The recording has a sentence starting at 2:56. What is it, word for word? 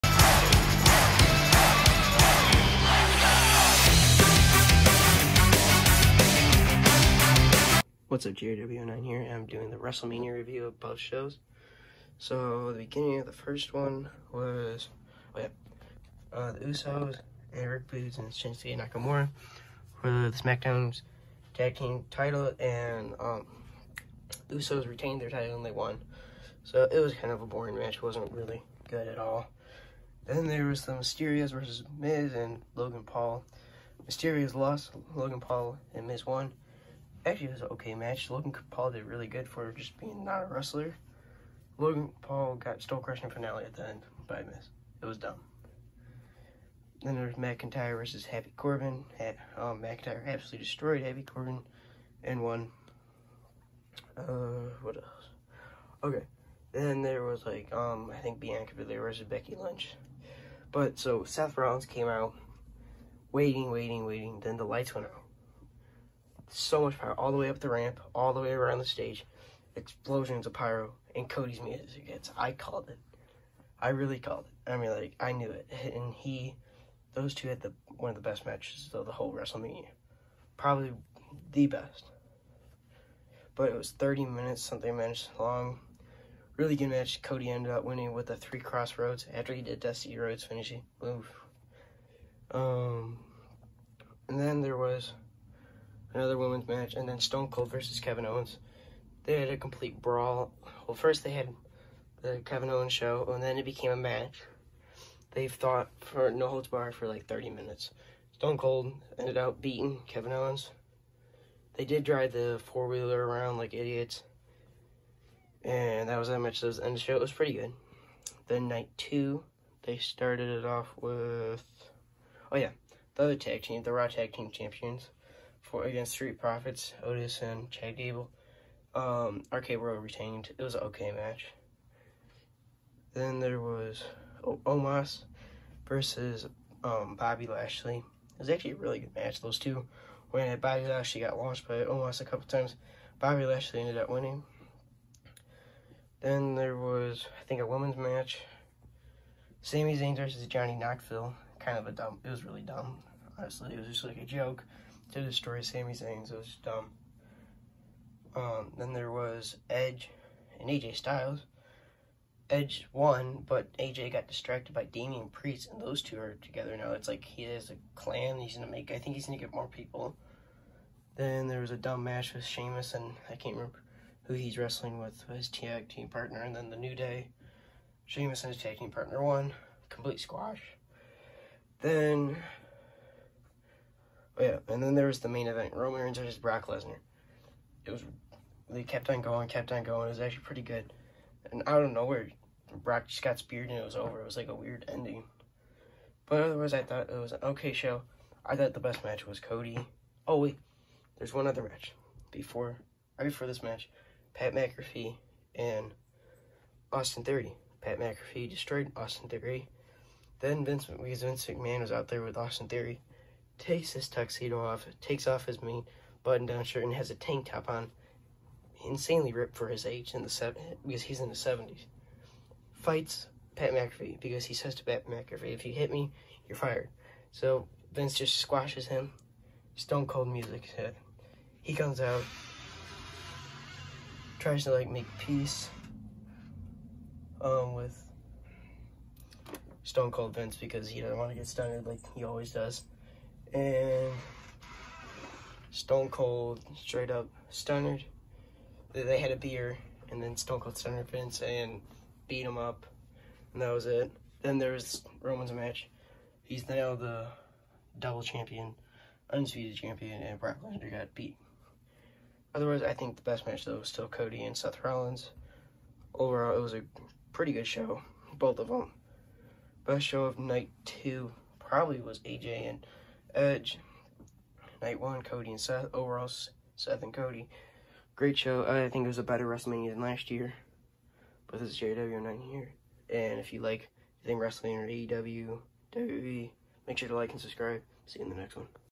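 And then the New Day, Sheamus and his tag team partner won.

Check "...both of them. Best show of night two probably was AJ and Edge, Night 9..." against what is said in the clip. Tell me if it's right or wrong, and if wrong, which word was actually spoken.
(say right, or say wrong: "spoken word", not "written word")
wrong: "1", not "9".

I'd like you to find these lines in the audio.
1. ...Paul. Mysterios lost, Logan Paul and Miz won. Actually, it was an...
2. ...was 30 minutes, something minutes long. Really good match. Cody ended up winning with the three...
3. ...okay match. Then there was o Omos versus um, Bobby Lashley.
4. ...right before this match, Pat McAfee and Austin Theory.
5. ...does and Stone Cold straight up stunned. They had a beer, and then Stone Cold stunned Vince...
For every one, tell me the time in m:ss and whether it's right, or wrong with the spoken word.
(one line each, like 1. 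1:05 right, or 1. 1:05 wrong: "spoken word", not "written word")
1. 0:33 right
2. 1:23 right
3. 2:10 right
4. 3:23 right
5. 4:02 right.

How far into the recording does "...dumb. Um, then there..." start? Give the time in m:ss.
2:36.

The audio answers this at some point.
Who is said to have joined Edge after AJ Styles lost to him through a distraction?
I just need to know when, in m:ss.
2:44.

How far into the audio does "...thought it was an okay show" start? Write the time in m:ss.
3:16.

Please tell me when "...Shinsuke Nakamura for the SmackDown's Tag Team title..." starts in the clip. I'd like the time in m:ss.
0:18.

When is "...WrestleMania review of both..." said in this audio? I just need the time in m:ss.
0:09.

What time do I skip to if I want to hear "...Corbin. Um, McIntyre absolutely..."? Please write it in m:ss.
0:48.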